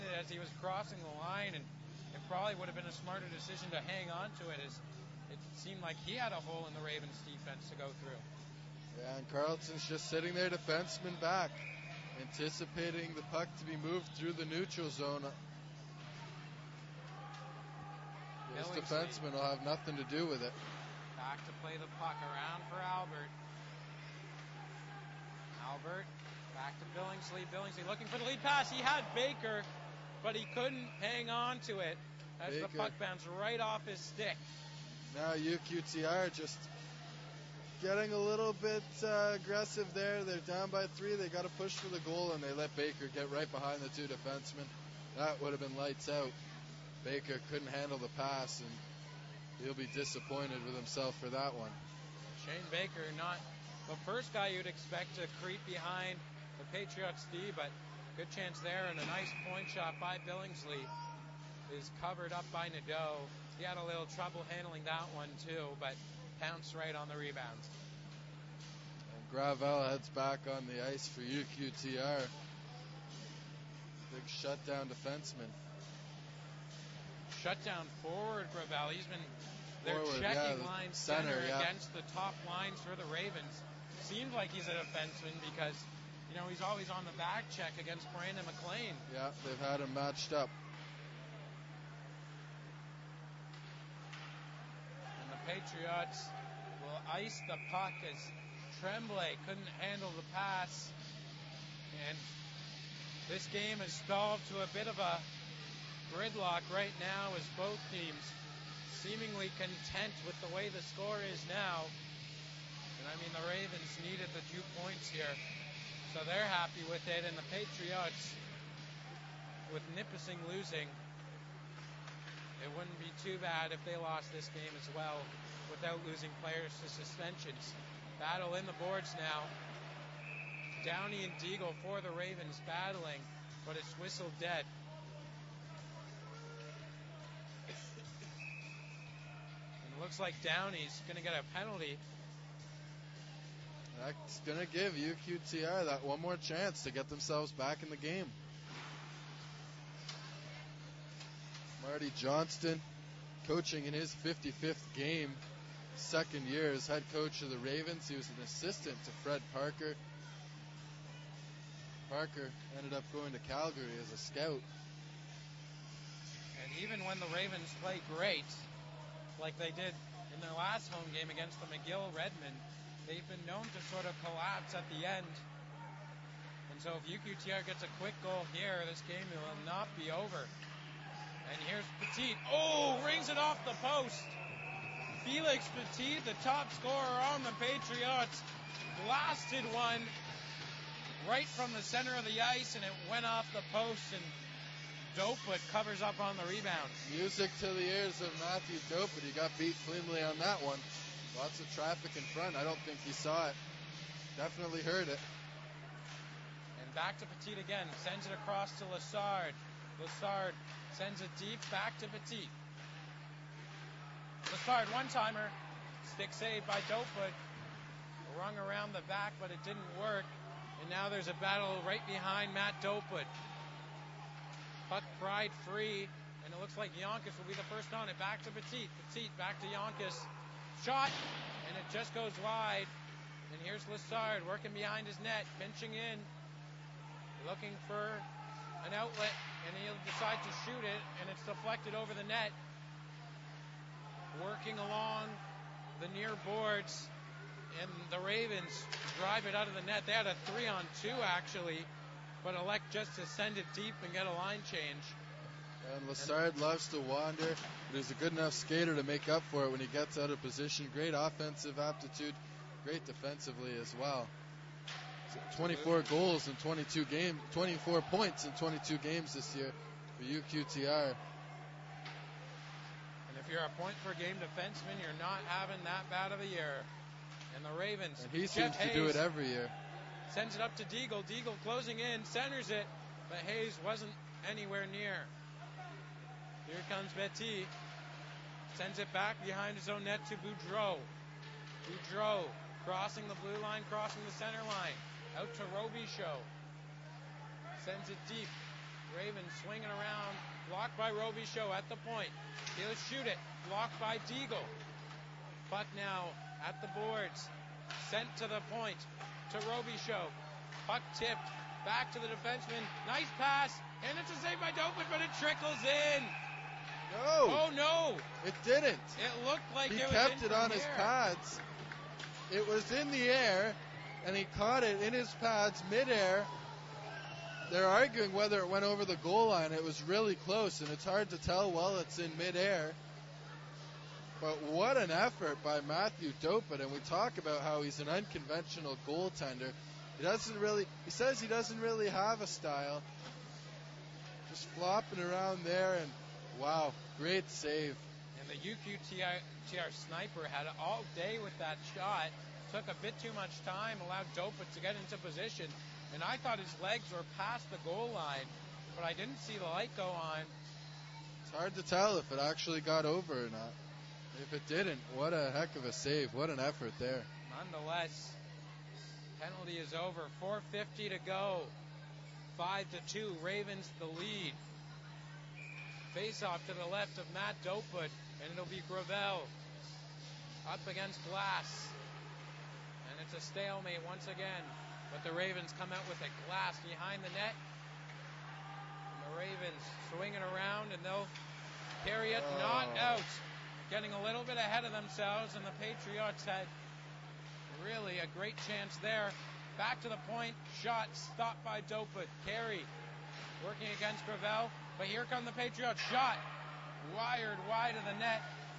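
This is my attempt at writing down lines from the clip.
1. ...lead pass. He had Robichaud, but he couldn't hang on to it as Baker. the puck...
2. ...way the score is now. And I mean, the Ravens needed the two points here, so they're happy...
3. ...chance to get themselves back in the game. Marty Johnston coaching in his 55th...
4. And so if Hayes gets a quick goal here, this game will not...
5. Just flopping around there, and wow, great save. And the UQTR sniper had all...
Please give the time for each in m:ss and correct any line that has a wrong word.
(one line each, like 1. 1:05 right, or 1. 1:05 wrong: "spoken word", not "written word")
1. 0:28 wrong: "Baker", not "Robichaud"
2. 1:50 right
3. 2:26 right
4. 2:56 wrong: "UQTR", not "Hayes"
5. 5:44 right.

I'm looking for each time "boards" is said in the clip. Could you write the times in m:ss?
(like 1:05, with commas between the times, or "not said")
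2:08, 4:06, 5:06.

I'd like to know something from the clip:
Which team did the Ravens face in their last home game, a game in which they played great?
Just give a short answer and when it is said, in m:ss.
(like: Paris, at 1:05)
McGill Redmen, at 2:51.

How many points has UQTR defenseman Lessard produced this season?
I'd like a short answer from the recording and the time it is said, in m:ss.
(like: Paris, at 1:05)
24, at 4:27.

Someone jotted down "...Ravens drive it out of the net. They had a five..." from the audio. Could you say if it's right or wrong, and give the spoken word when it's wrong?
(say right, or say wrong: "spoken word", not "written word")
wrong: "three", not "five".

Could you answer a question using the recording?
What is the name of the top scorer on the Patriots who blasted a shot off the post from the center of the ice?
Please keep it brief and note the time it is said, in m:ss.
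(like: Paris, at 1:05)
Felix Petit, at 3:05.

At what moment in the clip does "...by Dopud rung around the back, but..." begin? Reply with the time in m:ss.
3:36.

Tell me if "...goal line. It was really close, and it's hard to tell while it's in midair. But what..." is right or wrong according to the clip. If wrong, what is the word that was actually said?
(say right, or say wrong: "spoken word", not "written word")
right.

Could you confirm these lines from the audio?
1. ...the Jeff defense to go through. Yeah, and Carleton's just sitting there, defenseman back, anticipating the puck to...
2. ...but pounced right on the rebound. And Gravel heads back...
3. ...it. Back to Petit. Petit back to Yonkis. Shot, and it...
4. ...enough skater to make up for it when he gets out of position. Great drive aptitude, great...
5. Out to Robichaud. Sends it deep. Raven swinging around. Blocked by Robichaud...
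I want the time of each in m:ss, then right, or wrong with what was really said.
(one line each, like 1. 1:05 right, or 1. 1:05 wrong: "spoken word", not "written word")
1. 0:06 wrong: "Ravens", not "Jeff"
2. 1:05 right
3. 3:48 right
4. 4:18 wrong: "offensive", not "drive"
5. 4:55 right.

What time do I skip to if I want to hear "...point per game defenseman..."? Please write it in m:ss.
4:33.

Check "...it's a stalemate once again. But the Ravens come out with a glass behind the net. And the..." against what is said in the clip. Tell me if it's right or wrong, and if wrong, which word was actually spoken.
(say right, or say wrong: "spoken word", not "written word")
right.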